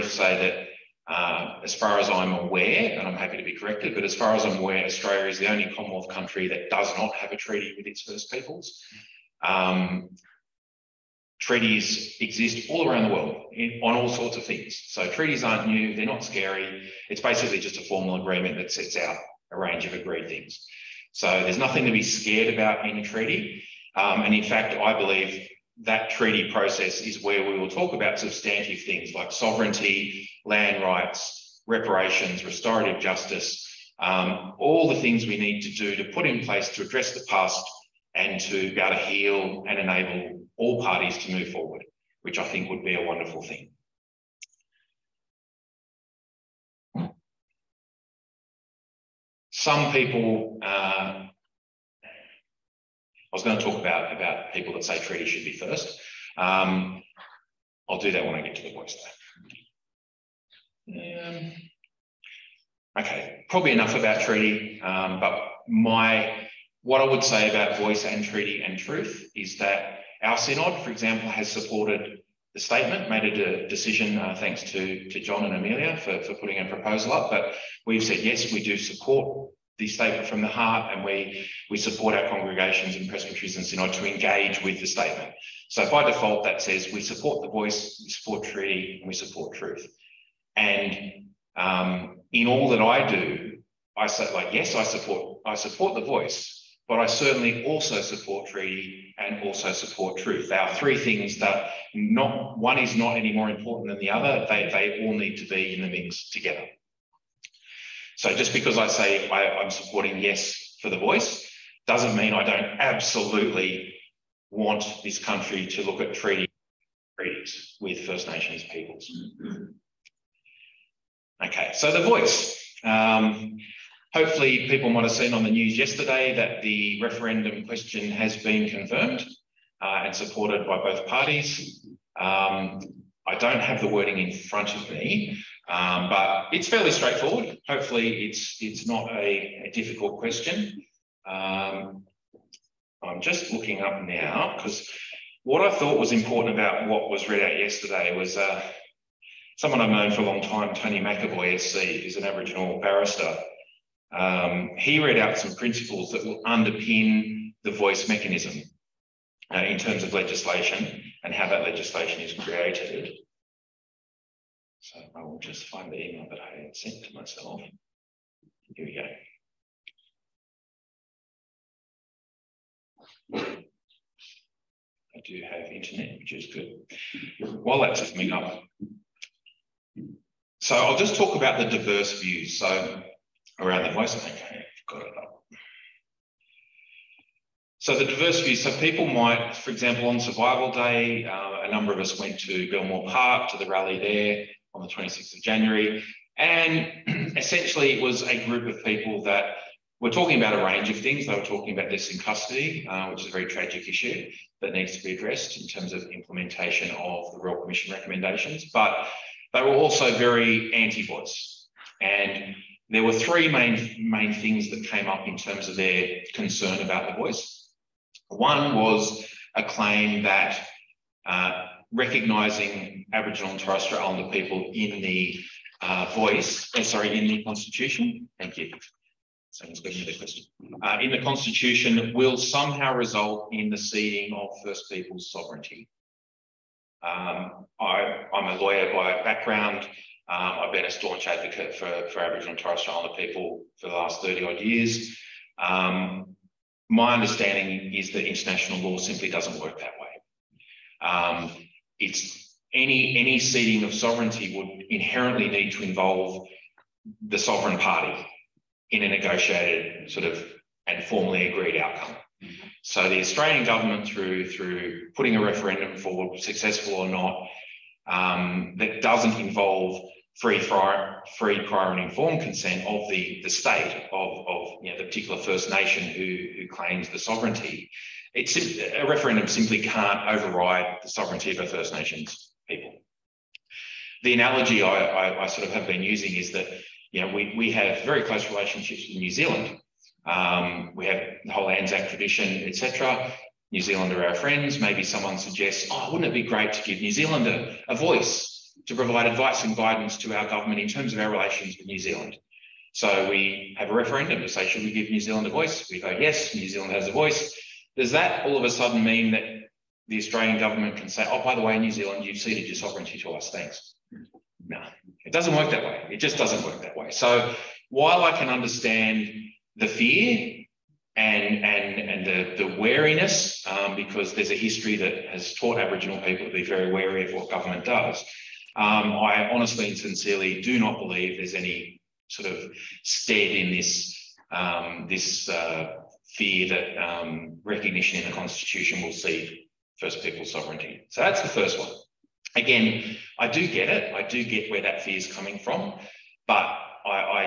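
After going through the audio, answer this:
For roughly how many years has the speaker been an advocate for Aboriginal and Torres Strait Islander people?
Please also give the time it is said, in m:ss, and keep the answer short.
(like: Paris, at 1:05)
30, at 4:04.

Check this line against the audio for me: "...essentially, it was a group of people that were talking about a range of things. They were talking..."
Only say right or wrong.
right.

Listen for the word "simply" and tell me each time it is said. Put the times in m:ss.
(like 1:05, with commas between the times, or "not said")
4:08, 4:39.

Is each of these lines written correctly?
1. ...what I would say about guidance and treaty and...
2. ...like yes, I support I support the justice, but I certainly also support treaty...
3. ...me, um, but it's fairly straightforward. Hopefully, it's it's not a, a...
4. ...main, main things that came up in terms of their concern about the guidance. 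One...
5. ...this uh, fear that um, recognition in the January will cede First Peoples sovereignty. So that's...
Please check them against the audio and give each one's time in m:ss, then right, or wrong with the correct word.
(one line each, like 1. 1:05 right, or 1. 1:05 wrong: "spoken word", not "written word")
1. 1:06 wrong: "voice", not "guidance"
2. 1:34 wrong: "voice", not "justice"
3. 2:14 right
4. 3:33 wrong: "voice", not "guidance"
5. 5:35 wrong: "Constitution", not "January".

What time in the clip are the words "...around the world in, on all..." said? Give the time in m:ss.
0:12.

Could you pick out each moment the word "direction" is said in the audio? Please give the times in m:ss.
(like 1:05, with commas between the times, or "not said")
not said.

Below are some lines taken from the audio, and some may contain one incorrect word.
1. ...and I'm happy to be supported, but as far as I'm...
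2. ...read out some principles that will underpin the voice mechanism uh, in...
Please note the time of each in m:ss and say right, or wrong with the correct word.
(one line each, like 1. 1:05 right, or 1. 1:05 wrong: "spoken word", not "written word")
1. 0:02 wrong: "corrected", not "supported"
2. 2:35 right.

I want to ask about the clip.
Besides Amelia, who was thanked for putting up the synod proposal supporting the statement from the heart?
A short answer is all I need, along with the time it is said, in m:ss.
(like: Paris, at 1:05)
John, at 1:15.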